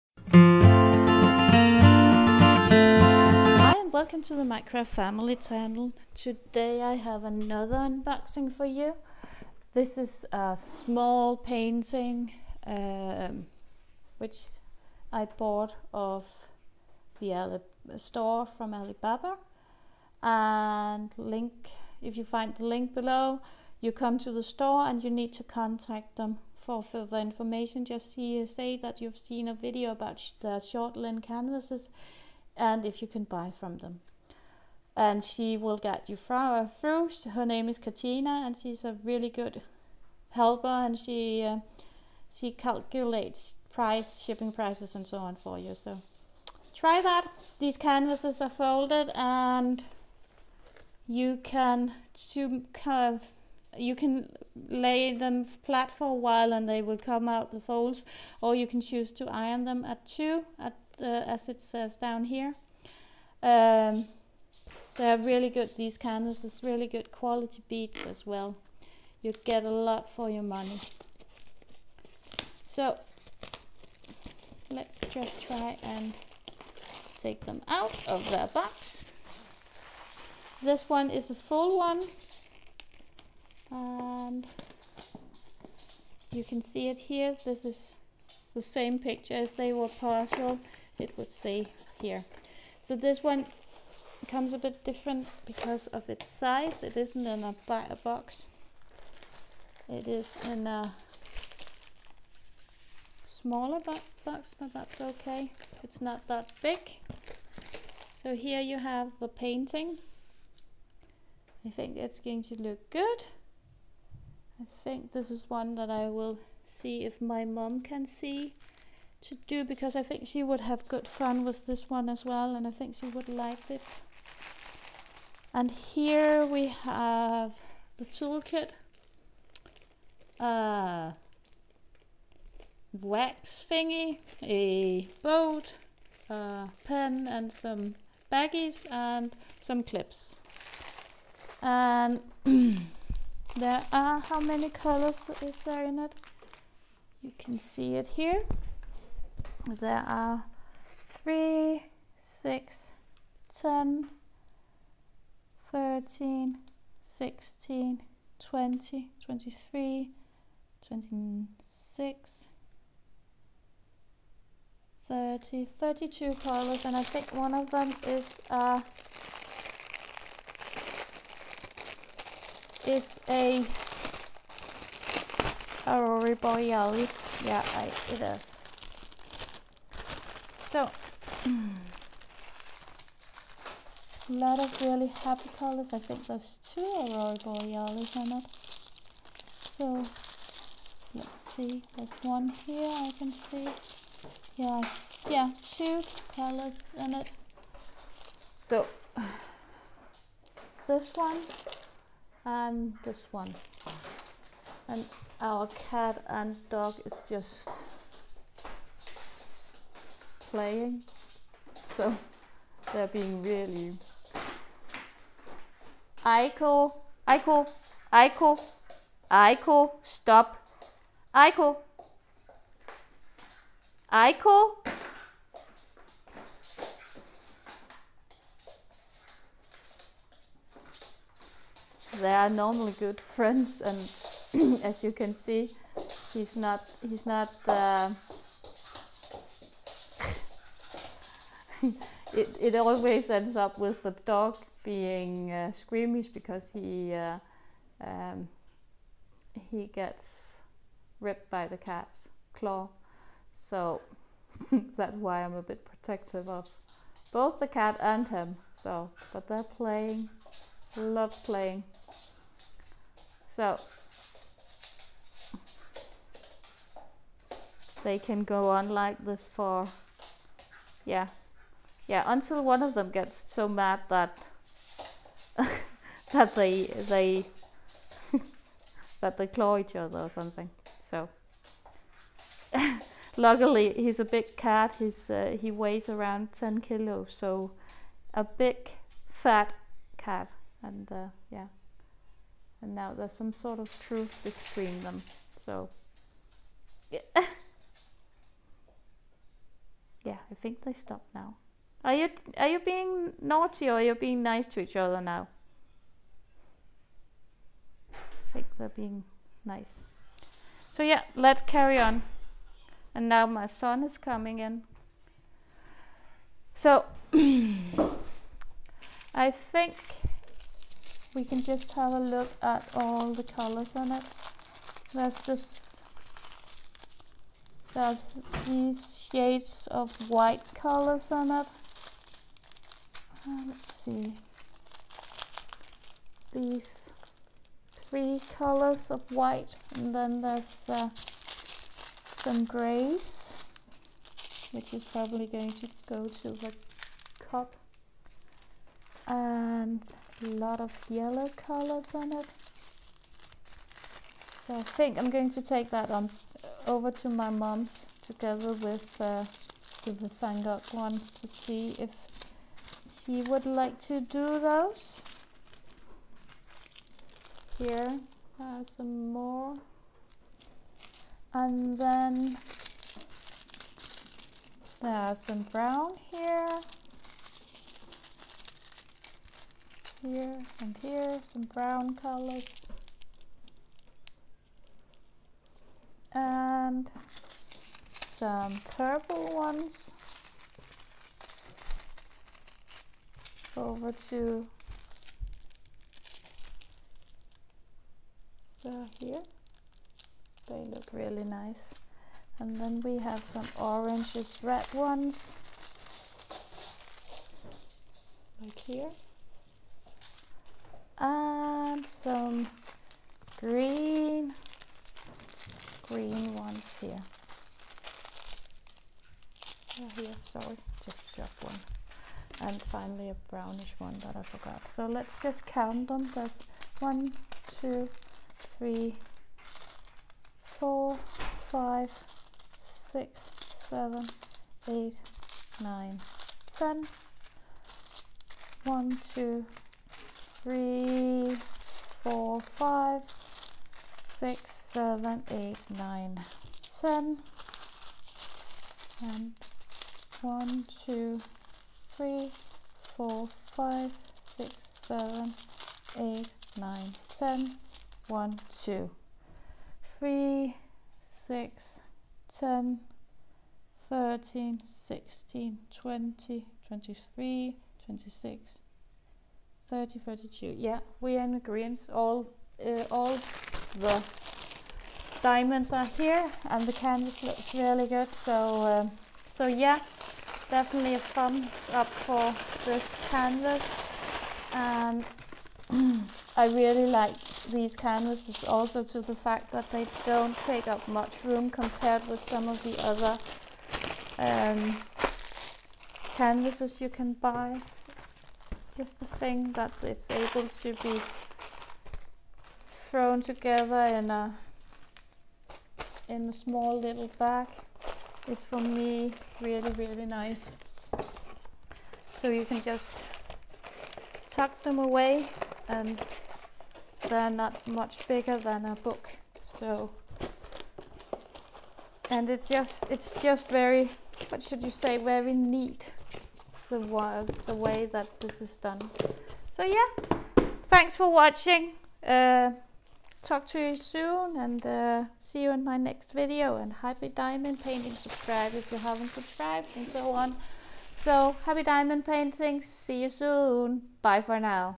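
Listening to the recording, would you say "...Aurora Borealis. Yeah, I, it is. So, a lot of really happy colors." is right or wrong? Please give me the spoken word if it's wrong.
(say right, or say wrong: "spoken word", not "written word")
right.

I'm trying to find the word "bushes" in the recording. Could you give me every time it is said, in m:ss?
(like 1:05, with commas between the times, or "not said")
not said.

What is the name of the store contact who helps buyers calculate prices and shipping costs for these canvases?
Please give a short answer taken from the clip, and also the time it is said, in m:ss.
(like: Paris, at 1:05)
Katina, at 0:37.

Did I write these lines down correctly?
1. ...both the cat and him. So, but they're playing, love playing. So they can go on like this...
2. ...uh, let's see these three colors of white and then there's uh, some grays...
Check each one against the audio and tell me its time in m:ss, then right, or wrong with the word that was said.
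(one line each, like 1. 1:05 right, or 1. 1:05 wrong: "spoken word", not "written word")
1. 4:17 right
2. 5:33 right.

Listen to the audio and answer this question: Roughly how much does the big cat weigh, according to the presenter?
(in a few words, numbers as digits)
10 kilos.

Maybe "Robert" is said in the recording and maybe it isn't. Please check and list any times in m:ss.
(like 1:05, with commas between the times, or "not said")
not said.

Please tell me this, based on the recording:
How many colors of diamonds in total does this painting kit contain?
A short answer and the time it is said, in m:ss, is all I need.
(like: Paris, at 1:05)
32, at 2:45.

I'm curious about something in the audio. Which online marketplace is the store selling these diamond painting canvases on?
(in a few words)
Alibaba.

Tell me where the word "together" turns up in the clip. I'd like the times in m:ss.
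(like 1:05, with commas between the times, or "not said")
5:58, 8:23.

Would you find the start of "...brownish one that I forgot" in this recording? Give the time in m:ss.
7:03.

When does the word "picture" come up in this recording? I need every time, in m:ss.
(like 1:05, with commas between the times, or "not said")
1:28.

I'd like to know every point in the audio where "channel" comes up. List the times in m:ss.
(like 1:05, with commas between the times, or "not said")
0:05.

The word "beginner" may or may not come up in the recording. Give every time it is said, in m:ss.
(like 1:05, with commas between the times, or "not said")
not said.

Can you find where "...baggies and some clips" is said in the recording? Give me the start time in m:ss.
2:18.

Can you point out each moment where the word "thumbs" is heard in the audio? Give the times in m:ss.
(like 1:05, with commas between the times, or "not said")
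8:01.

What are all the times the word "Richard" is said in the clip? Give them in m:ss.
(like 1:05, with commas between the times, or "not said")
not said.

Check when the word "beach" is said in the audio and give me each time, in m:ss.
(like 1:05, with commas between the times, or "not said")
not said.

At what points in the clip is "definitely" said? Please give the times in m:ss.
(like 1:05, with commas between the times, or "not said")
8:00.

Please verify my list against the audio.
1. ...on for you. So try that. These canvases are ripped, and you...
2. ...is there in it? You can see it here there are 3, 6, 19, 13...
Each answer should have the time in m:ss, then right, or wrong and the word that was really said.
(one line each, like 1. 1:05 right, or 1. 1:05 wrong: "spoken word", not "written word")
1. 0:45 wrong: "folded", not "ripped"
2. 2:25 wrong: "10", not "19".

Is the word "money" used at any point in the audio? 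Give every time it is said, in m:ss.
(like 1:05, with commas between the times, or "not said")
1:10.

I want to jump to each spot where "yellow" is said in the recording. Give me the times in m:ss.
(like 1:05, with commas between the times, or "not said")
5:51.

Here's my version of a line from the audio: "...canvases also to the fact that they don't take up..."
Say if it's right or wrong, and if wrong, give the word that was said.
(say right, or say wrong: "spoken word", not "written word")
right.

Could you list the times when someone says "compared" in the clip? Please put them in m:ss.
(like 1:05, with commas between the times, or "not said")
8:11.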